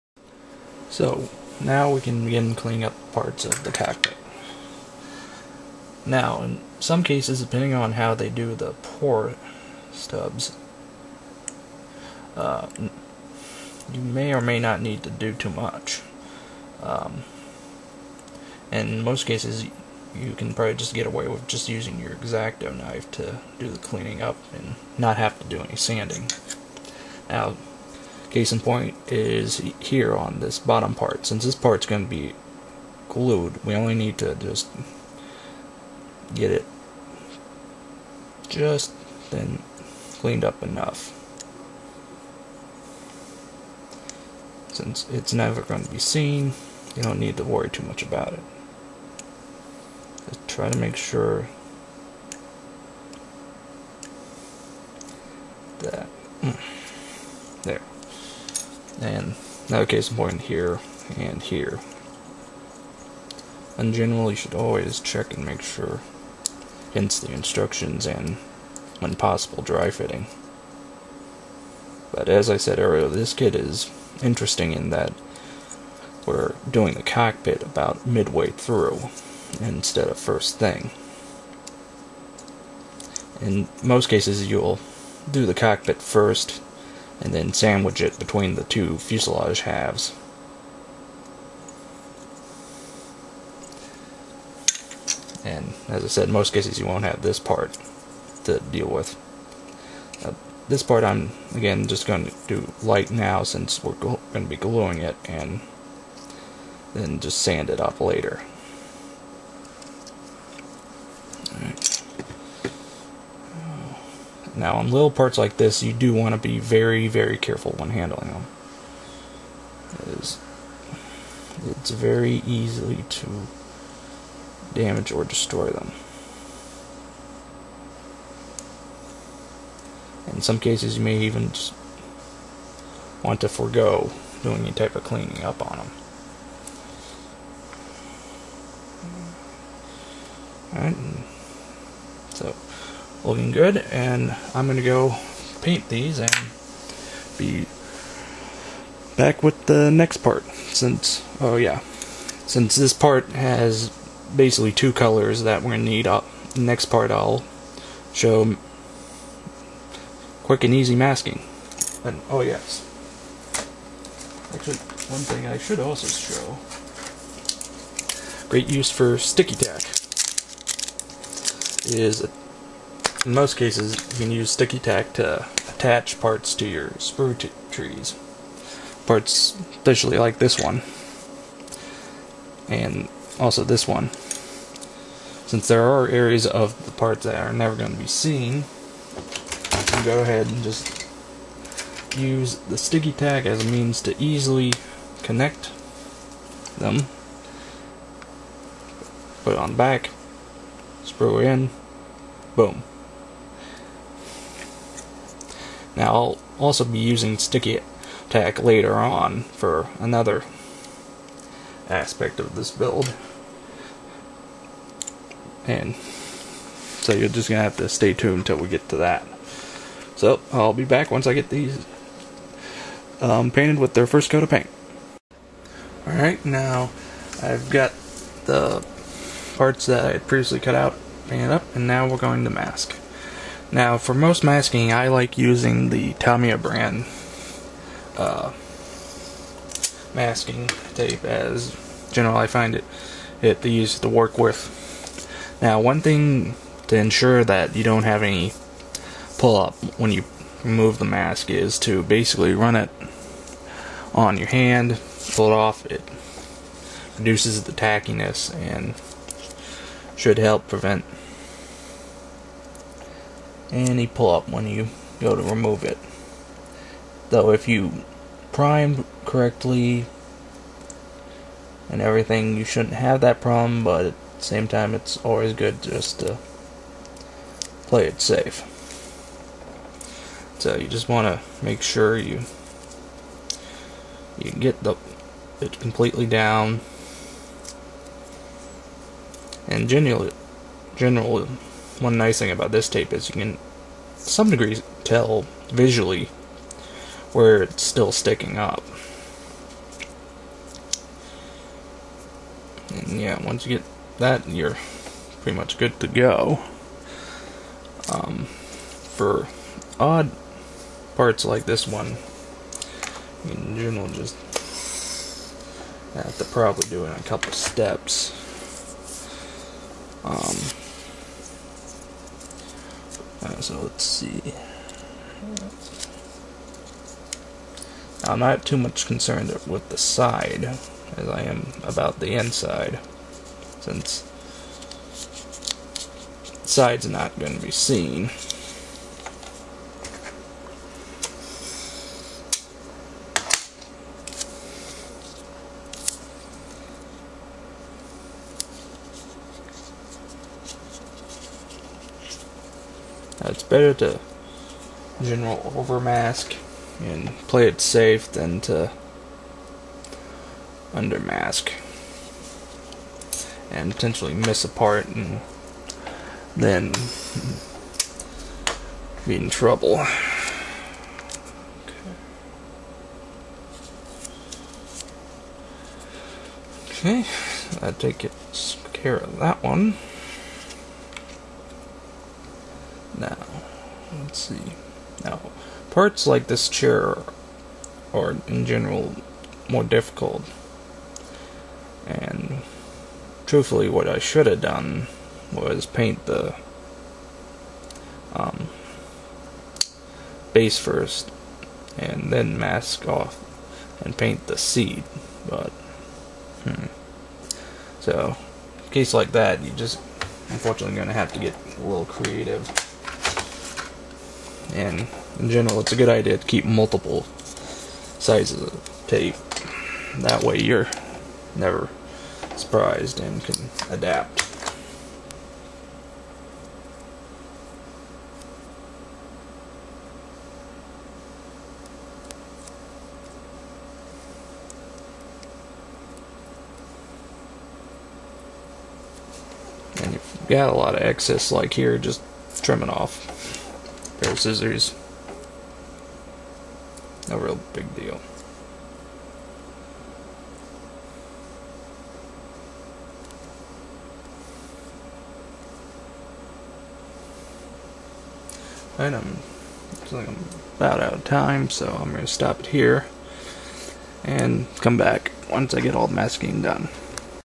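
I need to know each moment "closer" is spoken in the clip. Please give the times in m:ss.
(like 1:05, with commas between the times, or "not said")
not said.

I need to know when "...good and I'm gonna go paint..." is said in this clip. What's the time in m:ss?
2:23.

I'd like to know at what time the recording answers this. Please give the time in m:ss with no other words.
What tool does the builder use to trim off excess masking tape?
7:24.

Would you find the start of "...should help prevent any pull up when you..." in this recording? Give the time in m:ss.
4:20.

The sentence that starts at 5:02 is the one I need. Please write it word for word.
And yeah, once you get that, you're pretty much good to go.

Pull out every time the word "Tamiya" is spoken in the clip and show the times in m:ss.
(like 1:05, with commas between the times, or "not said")
3:56.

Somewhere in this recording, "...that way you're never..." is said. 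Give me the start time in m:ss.
7:00.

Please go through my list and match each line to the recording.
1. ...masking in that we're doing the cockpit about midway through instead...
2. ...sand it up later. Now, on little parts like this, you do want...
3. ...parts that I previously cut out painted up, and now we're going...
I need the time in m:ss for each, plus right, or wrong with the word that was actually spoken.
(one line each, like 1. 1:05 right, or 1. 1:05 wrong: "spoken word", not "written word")
1. 1:14 wrong: "interesting", not "masking"
2. 1:47 right
3. 3:49 right.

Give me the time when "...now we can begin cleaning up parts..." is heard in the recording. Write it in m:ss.
0:01.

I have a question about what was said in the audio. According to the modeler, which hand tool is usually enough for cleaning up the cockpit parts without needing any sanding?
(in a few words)
X-Acto knife.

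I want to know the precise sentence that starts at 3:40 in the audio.
So I'll be back once I get these um, painted with their first coat of paint.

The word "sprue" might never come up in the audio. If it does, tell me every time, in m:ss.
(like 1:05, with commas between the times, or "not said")
2:56, 3:21.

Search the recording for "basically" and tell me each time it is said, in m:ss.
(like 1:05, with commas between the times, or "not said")
2:34, 4:12.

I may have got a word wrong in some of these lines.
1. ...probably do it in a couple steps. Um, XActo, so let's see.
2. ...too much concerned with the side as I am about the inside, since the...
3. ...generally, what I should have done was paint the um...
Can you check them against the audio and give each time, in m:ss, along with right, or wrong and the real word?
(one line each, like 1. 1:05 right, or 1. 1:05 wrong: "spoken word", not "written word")
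1. 5:16 wrong: "Right", not "XActo"
2. 5:28 right
3. 6:33 wrong: "truthfully", not "generally".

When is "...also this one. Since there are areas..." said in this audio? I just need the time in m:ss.
3:03.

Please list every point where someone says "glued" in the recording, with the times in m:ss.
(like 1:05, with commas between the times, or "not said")
0:33.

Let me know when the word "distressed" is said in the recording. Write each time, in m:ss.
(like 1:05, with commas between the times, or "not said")
not said.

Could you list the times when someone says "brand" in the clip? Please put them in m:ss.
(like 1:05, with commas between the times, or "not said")
3:56.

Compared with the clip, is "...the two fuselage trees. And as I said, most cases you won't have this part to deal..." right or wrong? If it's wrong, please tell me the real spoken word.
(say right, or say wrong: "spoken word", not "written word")
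wrong: "halves", not "trees".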